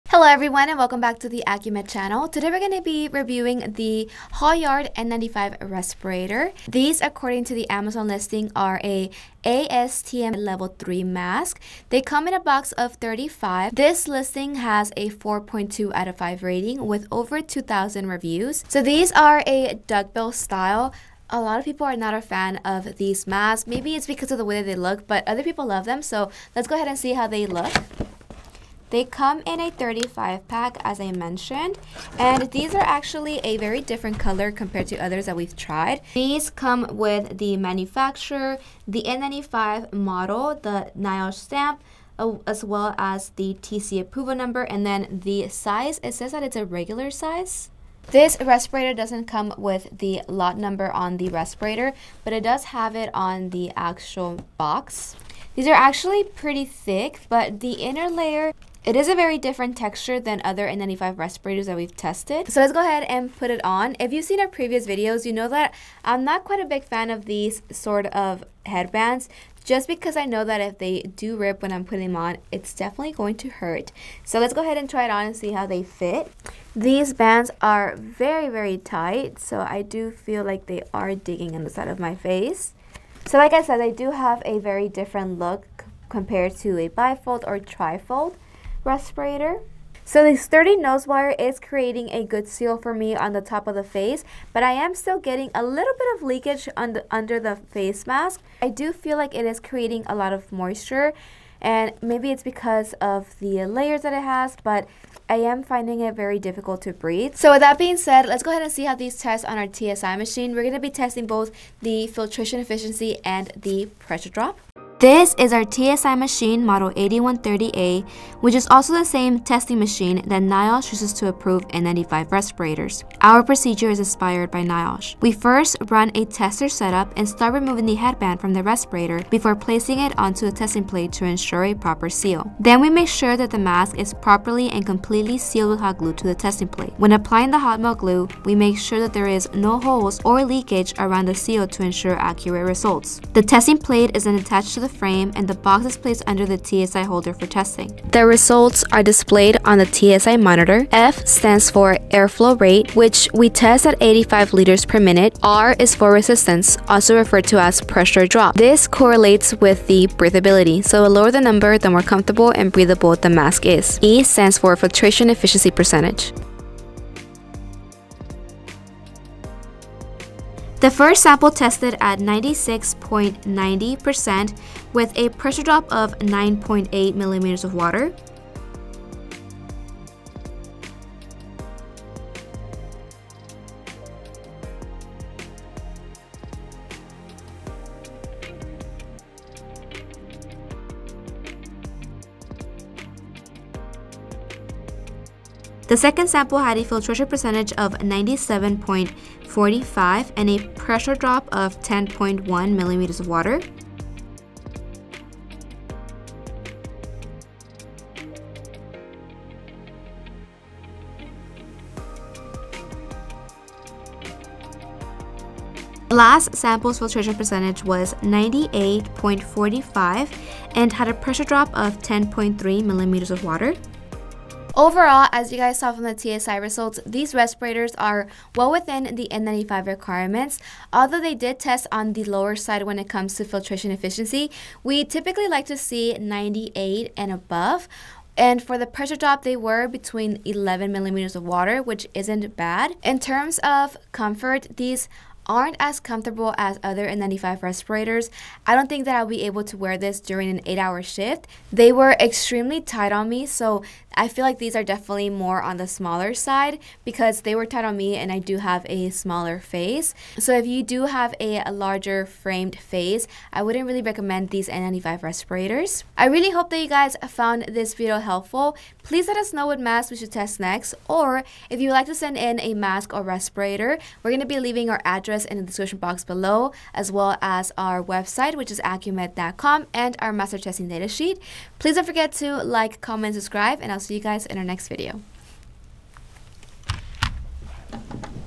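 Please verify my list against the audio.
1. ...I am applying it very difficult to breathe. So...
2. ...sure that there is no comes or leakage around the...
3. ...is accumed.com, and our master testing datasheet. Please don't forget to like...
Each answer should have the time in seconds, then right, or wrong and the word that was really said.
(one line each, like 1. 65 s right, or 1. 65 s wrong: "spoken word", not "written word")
1. 105 s wrong: "finding", not "applying"
2. 138 s wrong: "holes", not "comes"
3. 278 s right.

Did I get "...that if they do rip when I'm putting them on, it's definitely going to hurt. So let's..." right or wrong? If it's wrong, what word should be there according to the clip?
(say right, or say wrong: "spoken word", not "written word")
right.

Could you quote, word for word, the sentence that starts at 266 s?
I really hope that you guys found this video helpful.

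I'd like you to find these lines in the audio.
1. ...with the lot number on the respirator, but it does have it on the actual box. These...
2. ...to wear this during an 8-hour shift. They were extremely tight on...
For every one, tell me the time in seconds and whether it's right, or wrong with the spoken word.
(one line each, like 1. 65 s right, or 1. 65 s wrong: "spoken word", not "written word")
1. 49 s right
2. 249 s right.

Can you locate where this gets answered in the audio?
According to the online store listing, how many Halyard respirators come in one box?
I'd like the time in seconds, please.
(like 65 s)
12 s.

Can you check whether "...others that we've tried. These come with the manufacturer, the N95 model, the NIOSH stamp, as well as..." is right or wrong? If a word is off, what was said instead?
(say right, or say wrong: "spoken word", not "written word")
right.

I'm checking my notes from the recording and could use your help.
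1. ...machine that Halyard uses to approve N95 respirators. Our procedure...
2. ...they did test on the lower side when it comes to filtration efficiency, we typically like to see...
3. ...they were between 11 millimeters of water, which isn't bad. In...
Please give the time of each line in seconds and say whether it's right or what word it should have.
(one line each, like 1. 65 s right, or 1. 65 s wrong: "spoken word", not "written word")
1. 119 s wrong: "NIOSH", not "Halyard"
2. 231 s right
3. 239 s right.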